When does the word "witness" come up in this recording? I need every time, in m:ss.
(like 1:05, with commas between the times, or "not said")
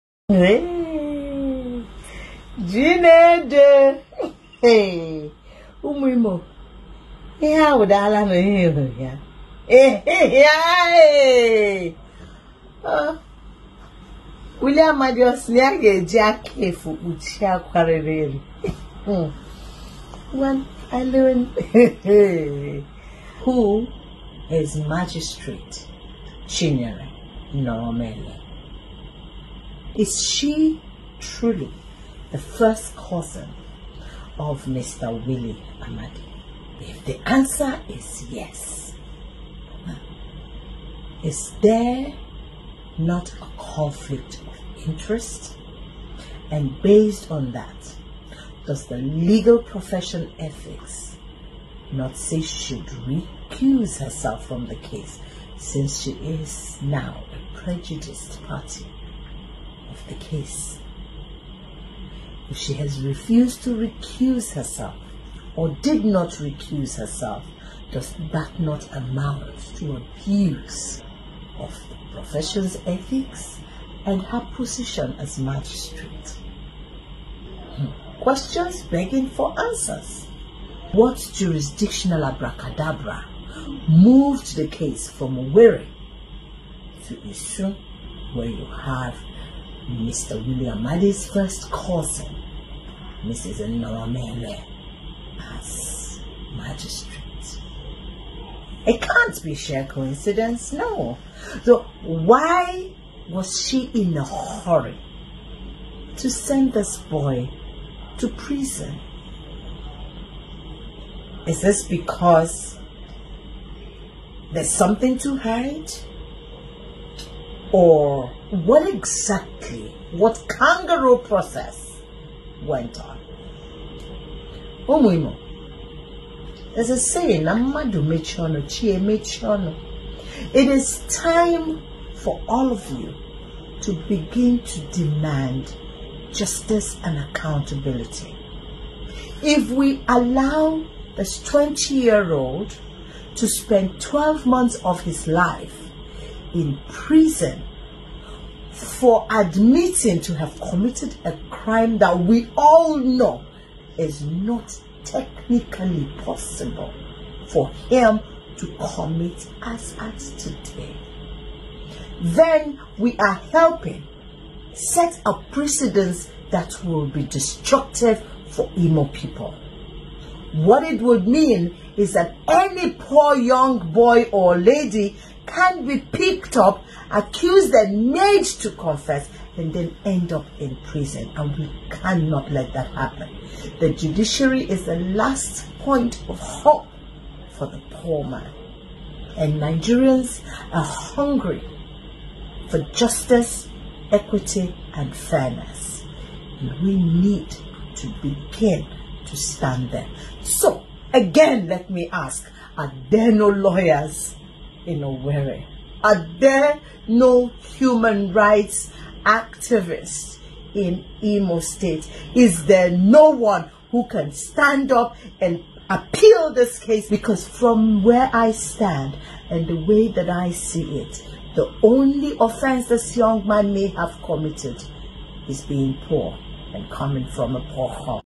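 not said.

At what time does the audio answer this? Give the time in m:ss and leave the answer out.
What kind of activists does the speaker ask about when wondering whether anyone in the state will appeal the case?
3:27.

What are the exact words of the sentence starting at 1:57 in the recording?
or what exactly, what kangaroo process went on.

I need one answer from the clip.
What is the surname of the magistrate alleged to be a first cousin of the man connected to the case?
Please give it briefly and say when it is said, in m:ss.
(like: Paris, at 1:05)
Nọrọmele, at 0:26.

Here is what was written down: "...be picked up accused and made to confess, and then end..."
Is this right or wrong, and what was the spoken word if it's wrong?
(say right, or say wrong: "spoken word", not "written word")
right.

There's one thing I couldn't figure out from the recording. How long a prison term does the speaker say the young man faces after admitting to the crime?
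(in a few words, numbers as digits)
12 months.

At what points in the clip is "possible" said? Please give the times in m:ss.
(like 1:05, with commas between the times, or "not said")
2:36.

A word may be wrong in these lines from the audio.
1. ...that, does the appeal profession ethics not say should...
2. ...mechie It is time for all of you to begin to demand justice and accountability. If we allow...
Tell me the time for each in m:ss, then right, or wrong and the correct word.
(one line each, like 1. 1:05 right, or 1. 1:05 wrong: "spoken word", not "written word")
1. 0:47 wrong: "legal", not "appeal"
2. 2:08 right.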